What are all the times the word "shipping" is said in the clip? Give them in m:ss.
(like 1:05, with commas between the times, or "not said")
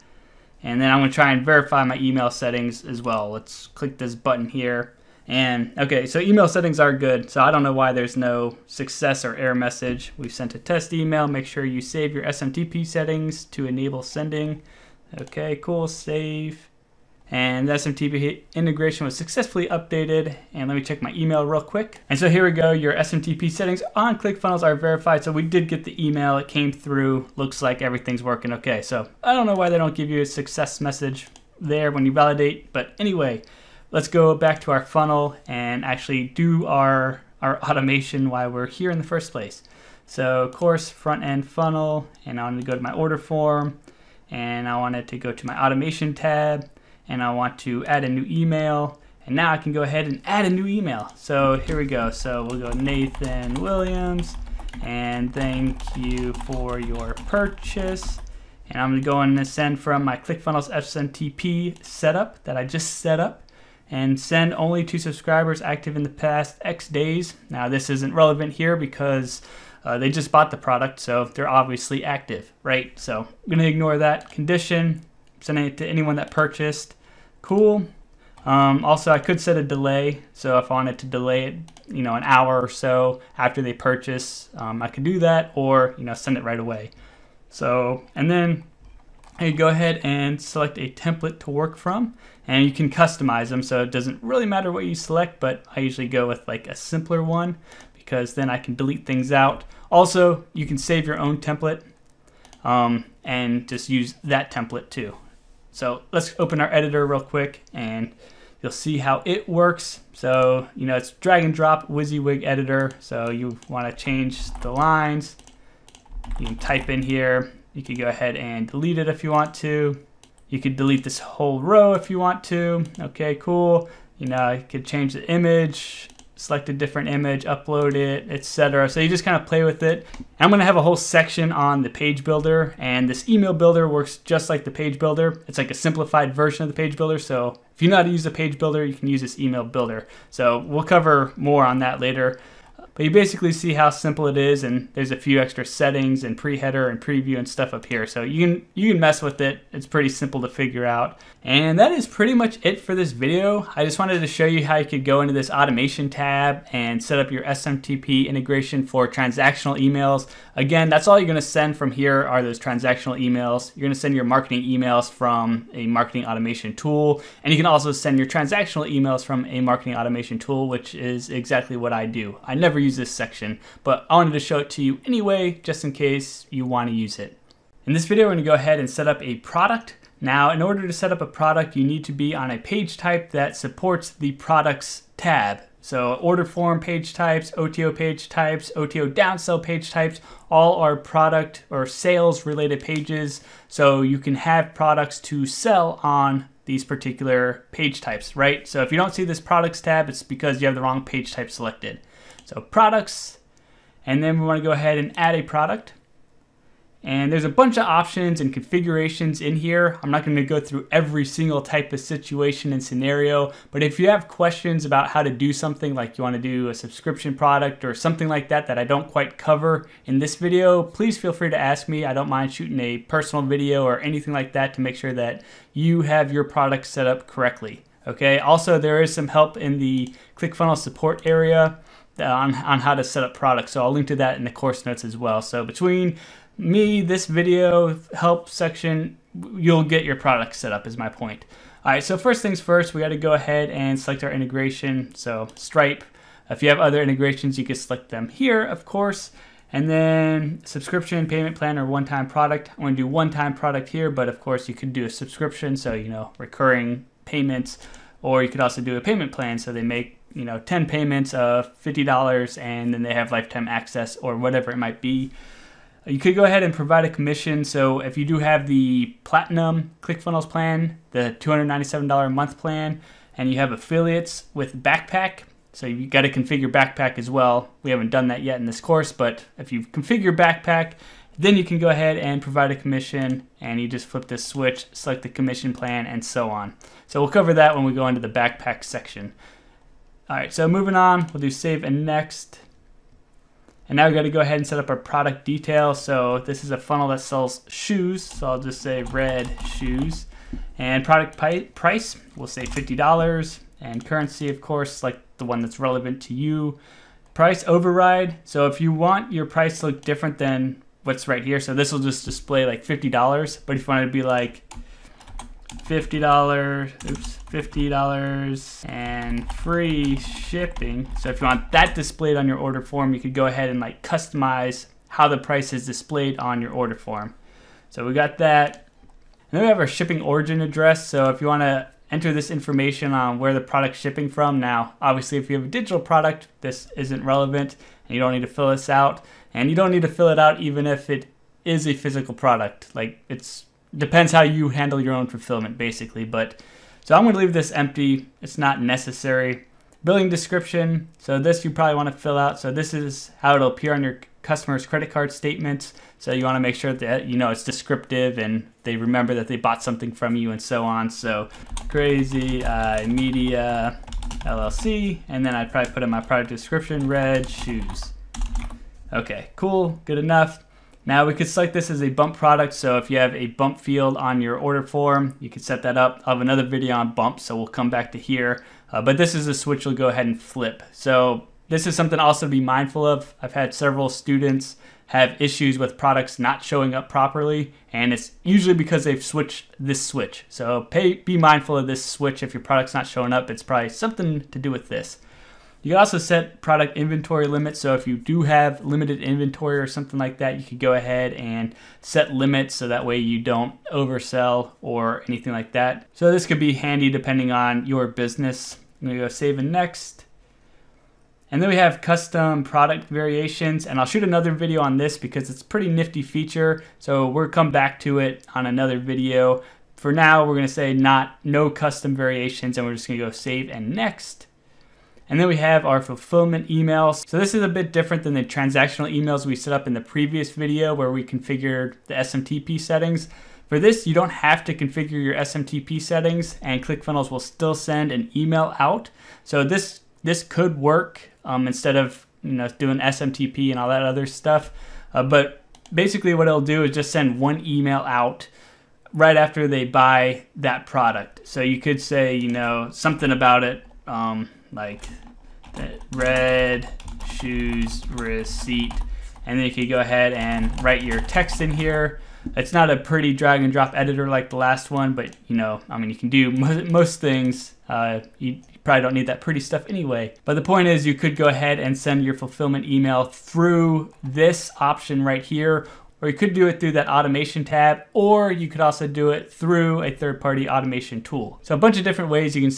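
5:20, 5:29, 5:33.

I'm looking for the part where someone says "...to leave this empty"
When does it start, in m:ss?
5:47.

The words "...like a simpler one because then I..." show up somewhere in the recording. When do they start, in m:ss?
1:36.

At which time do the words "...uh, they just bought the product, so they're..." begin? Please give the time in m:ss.
1:09.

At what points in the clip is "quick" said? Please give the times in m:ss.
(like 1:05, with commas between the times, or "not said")
0:21, 1:47.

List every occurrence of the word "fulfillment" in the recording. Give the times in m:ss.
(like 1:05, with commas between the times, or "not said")
5:45, 7:06, 7:52.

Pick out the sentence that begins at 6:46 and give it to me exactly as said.
So this could be handy depending on your business.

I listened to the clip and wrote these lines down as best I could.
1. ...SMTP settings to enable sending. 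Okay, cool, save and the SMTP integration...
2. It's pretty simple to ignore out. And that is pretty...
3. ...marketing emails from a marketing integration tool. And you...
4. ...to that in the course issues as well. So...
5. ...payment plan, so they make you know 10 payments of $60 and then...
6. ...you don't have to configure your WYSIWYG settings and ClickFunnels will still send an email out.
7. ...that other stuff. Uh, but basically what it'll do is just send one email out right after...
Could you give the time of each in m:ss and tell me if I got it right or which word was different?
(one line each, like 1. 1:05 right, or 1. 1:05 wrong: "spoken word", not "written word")
1. 0:12 right
2. 2:29 wrong: "figure", not "ignore"
3. 2:44 wrong: "automation", not "integration"
4. 3:54 wrong: "notes", not "issues"
5. 4:19 wrong: "50", not "60"
6. 7:14 wrong: "SMTP", not "WYSIWYG"
7. 7:23 right.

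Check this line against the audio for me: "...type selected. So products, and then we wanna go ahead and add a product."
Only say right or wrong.
right.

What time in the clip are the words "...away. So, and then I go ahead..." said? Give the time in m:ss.
1:26.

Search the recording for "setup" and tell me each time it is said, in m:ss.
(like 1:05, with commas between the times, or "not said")
1:01.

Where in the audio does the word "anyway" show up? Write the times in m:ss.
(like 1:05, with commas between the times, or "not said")
0:32, 2:55, 7:49.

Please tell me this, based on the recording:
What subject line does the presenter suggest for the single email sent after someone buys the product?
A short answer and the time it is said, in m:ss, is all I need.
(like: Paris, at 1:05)
red shoes receipt, at 7:36.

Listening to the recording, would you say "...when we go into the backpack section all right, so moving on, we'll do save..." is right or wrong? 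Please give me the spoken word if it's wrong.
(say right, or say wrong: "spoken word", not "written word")
right.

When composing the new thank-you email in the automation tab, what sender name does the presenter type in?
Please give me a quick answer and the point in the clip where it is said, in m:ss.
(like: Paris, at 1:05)
Nathan Williams, at 0:52.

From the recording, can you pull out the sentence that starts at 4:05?
So Stripe, if you have other integrations, you can select them here, of course.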